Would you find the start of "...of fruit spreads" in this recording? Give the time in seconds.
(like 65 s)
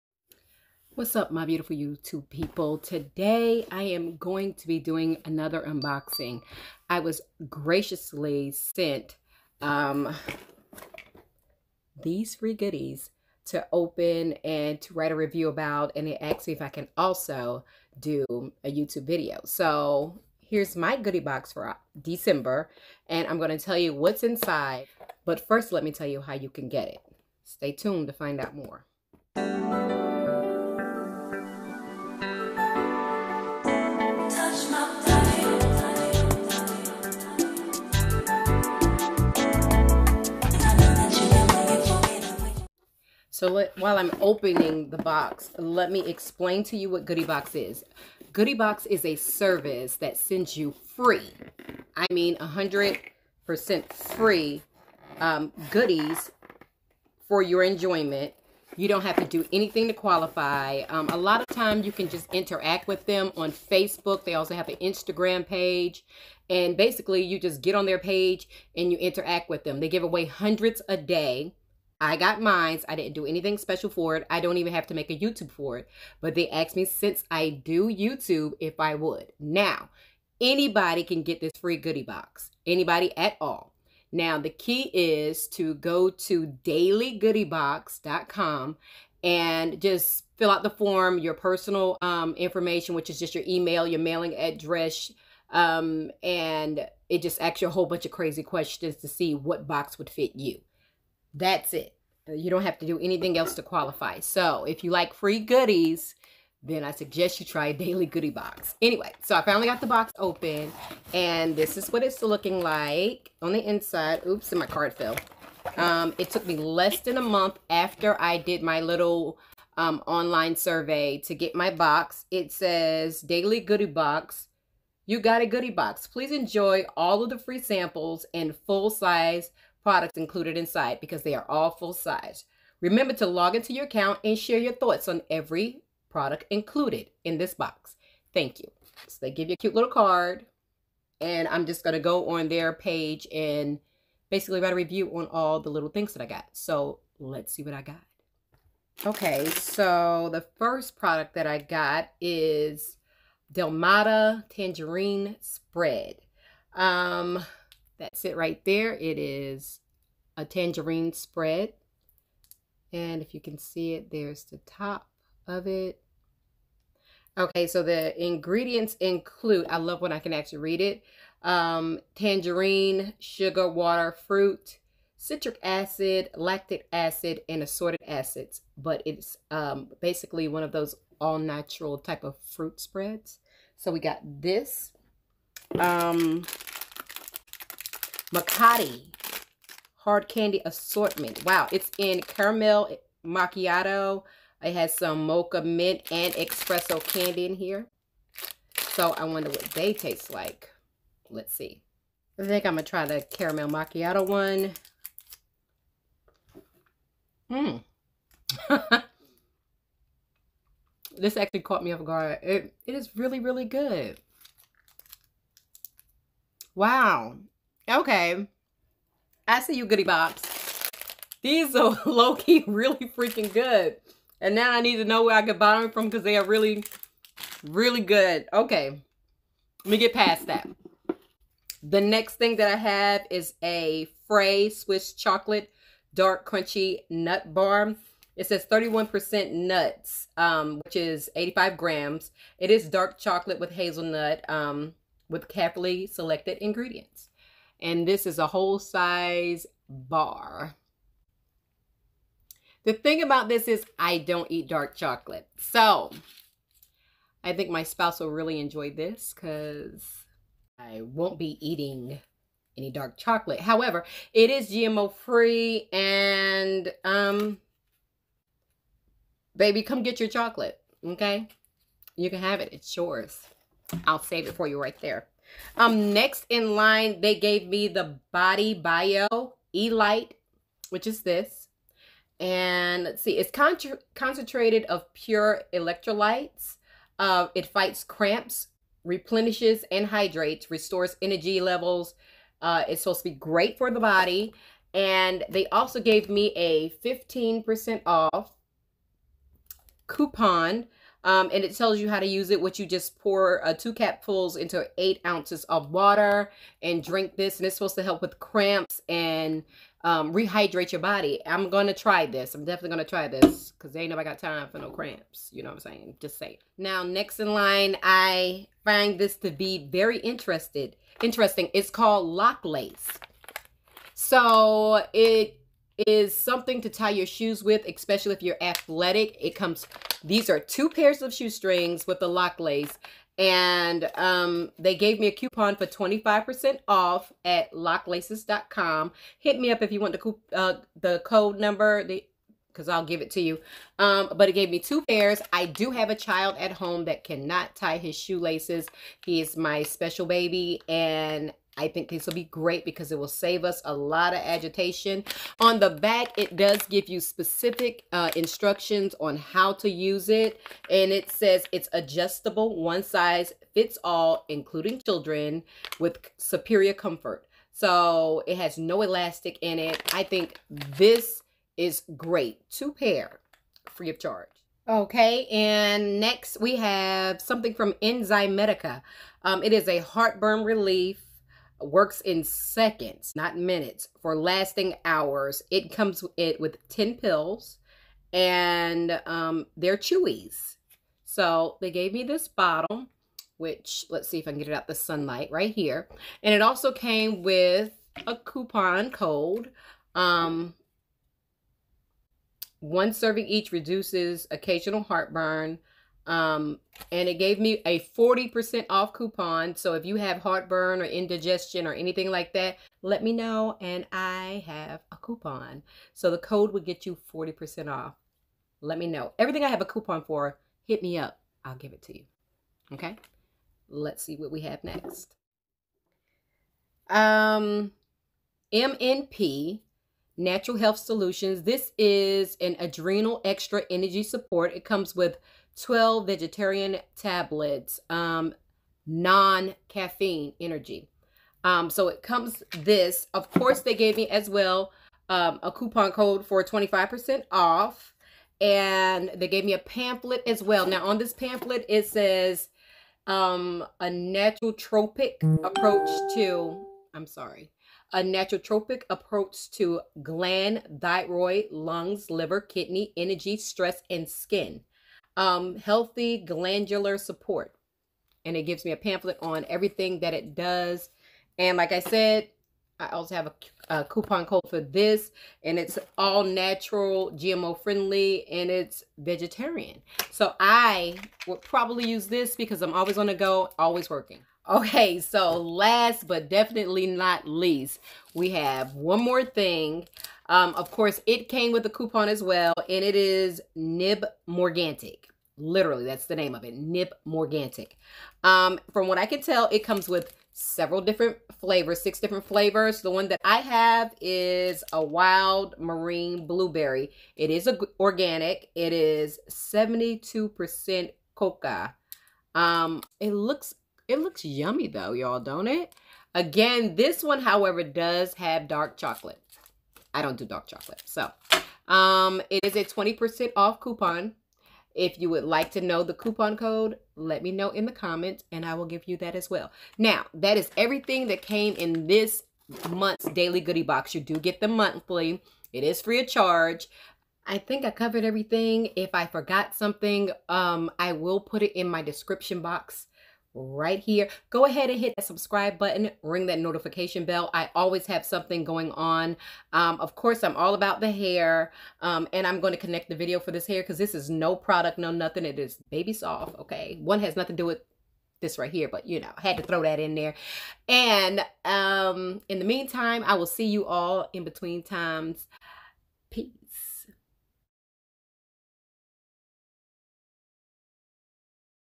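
182 s.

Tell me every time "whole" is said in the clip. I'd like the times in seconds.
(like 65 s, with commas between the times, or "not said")
97 s, 248 s.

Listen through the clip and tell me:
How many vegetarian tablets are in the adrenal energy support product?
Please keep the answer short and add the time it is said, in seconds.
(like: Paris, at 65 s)
12, at 435 s.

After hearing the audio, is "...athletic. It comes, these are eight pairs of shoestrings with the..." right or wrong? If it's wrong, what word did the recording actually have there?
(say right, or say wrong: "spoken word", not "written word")
wrong: "two", not "eight".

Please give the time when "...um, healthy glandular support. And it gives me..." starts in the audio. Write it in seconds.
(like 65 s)
465 s.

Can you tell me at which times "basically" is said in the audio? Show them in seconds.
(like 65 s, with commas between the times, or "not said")
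66 s, 144 s, 180 s.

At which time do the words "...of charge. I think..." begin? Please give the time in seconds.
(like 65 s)
536 s.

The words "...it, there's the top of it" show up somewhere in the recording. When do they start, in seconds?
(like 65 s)
163 s.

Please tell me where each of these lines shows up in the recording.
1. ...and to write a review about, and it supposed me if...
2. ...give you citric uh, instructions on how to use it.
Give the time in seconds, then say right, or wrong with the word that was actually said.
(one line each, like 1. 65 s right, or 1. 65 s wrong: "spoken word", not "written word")
1. 14 s wrong: "asked", not "supposed"
2. 356 s wrong: "specific", not "citric".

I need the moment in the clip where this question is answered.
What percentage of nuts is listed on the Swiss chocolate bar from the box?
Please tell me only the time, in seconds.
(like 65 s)
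238 s.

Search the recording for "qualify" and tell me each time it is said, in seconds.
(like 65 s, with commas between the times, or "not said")
59 s, 103 s.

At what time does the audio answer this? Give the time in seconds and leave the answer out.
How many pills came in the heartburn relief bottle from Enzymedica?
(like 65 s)
386 s.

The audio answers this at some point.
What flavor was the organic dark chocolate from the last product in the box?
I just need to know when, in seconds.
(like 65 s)
505 s.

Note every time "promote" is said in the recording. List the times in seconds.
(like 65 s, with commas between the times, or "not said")
not said.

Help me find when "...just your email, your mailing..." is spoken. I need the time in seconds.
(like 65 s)
93 s.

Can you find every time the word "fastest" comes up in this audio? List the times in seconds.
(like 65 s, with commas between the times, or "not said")
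not said.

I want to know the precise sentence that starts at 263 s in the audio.
However, it is GMO free and um, baby, come get your chocolate, okay?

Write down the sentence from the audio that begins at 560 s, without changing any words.
And um, in the meantime, I will see you all in between times.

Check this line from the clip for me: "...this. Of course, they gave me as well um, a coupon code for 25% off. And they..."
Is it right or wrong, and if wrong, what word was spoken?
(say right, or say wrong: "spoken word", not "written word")
right.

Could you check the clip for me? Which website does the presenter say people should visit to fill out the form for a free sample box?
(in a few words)
dailygoodiebox.com.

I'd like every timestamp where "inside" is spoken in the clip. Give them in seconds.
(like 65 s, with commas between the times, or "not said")
24 s, 113 s, 130 s.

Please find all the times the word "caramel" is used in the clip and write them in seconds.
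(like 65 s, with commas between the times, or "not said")
192 s, 203 s.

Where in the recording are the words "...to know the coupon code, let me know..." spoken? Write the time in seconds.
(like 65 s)
525 s.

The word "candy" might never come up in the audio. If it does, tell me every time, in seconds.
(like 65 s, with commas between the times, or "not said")
190 s, 197 s.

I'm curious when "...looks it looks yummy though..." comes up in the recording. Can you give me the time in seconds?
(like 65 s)
513 s.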